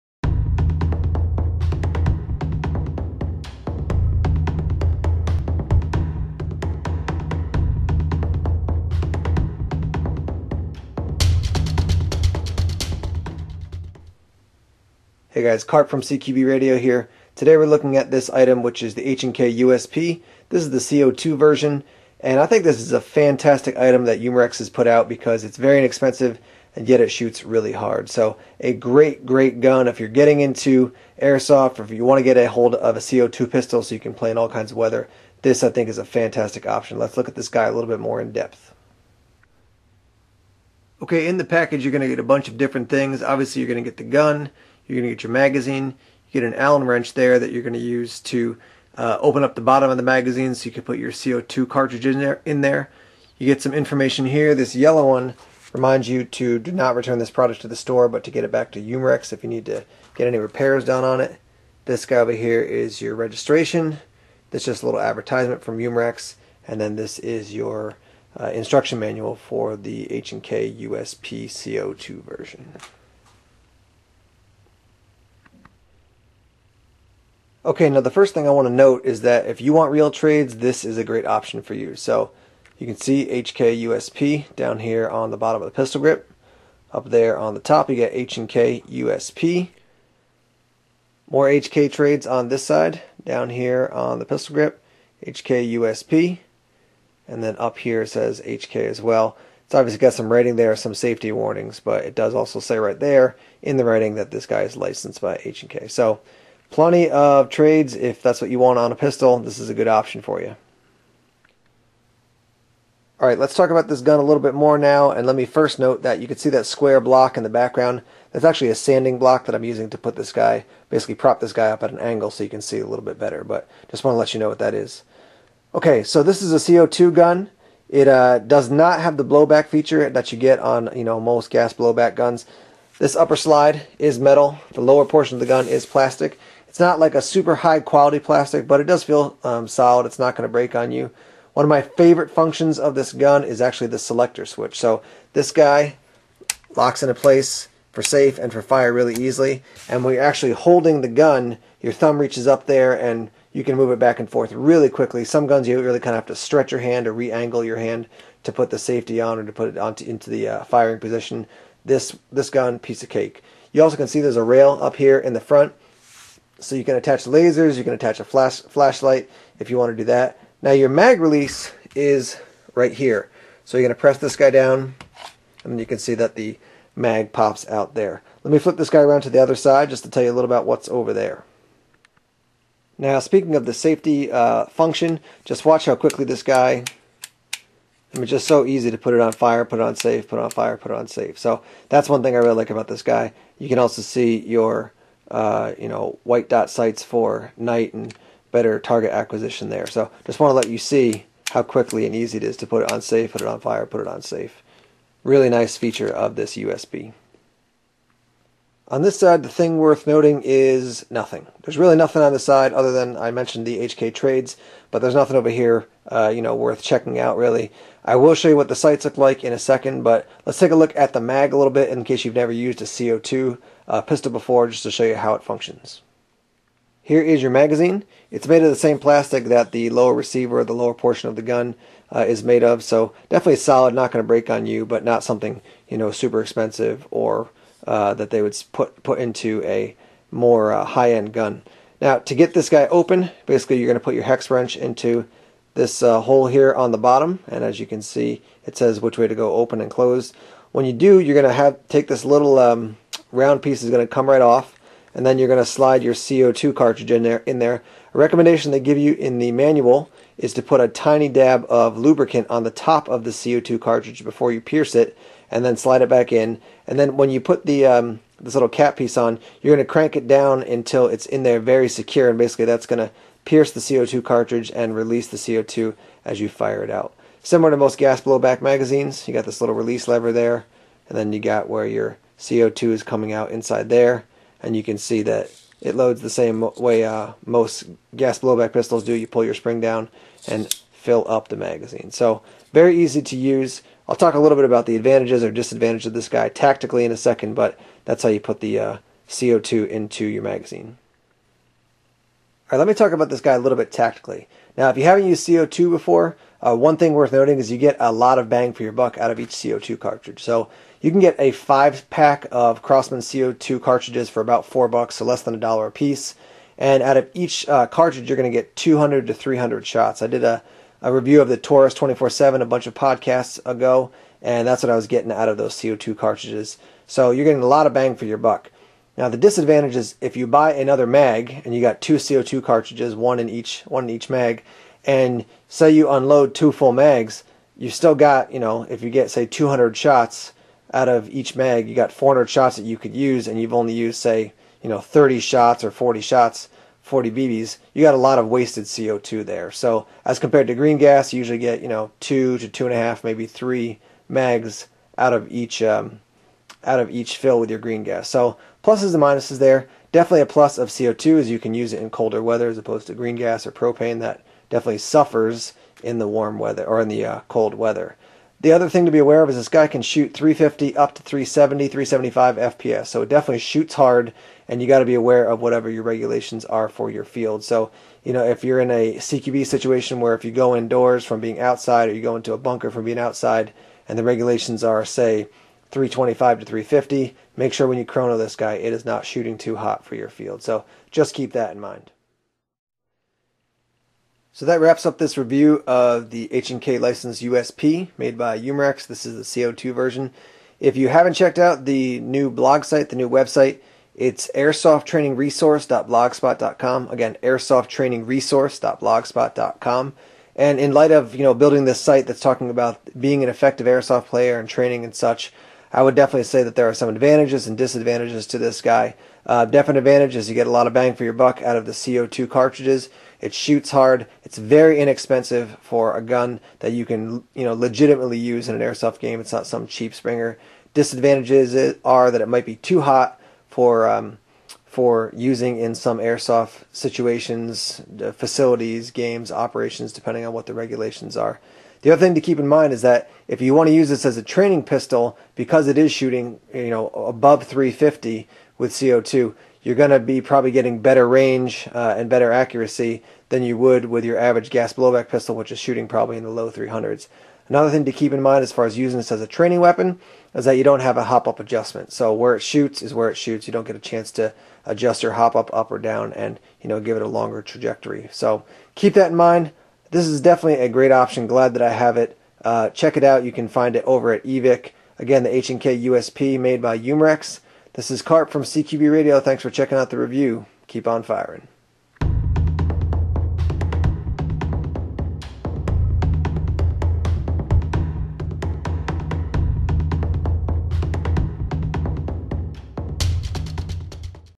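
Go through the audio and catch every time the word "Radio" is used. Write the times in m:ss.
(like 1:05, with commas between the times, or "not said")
0:16, 7:59.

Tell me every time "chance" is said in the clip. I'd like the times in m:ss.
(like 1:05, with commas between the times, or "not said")
7:43.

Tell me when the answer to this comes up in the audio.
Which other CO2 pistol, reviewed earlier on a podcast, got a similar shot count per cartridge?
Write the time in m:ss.
5:21.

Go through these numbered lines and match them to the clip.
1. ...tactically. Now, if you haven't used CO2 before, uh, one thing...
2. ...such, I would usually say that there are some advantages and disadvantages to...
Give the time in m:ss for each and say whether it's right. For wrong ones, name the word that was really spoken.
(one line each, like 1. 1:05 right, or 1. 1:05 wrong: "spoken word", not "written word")
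1. 5:03 right
2. 6:55 wrong: "definitely", not "usually".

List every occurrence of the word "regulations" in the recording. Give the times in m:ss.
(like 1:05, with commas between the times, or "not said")
6:16, 6:24, 7:20.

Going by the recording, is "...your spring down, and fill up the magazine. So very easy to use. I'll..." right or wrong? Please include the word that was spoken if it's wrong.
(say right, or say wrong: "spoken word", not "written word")
right.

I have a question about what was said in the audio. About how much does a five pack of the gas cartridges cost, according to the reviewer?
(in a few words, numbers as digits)
4 dollars.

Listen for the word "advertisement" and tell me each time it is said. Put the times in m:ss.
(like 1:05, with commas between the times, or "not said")
1:04.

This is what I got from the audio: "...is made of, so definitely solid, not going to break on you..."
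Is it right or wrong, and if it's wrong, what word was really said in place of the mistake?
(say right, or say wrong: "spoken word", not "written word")
right.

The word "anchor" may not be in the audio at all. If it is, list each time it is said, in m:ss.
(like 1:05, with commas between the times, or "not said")
not said.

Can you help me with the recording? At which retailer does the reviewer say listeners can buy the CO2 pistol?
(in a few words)
Evike.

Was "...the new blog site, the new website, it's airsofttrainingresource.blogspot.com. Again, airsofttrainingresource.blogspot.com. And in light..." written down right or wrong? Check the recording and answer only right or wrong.
right.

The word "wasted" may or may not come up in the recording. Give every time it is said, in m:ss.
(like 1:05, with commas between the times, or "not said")
5:48.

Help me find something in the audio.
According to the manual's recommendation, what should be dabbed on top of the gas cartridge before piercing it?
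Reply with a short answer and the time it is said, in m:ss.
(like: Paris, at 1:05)
lubricant, at 4:21.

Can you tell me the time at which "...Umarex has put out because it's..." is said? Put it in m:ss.
0:24.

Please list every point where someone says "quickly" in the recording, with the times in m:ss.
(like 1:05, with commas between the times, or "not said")
2:34, 3:05, 3:21.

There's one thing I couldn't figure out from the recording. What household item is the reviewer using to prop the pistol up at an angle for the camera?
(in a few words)
sanding block.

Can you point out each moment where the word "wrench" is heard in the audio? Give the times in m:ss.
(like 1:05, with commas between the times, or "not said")
0:46, 4:04.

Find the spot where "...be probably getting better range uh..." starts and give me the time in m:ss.
7:30.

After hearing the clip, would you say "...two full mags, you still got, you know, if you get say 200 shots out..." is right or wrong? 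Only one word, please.
right.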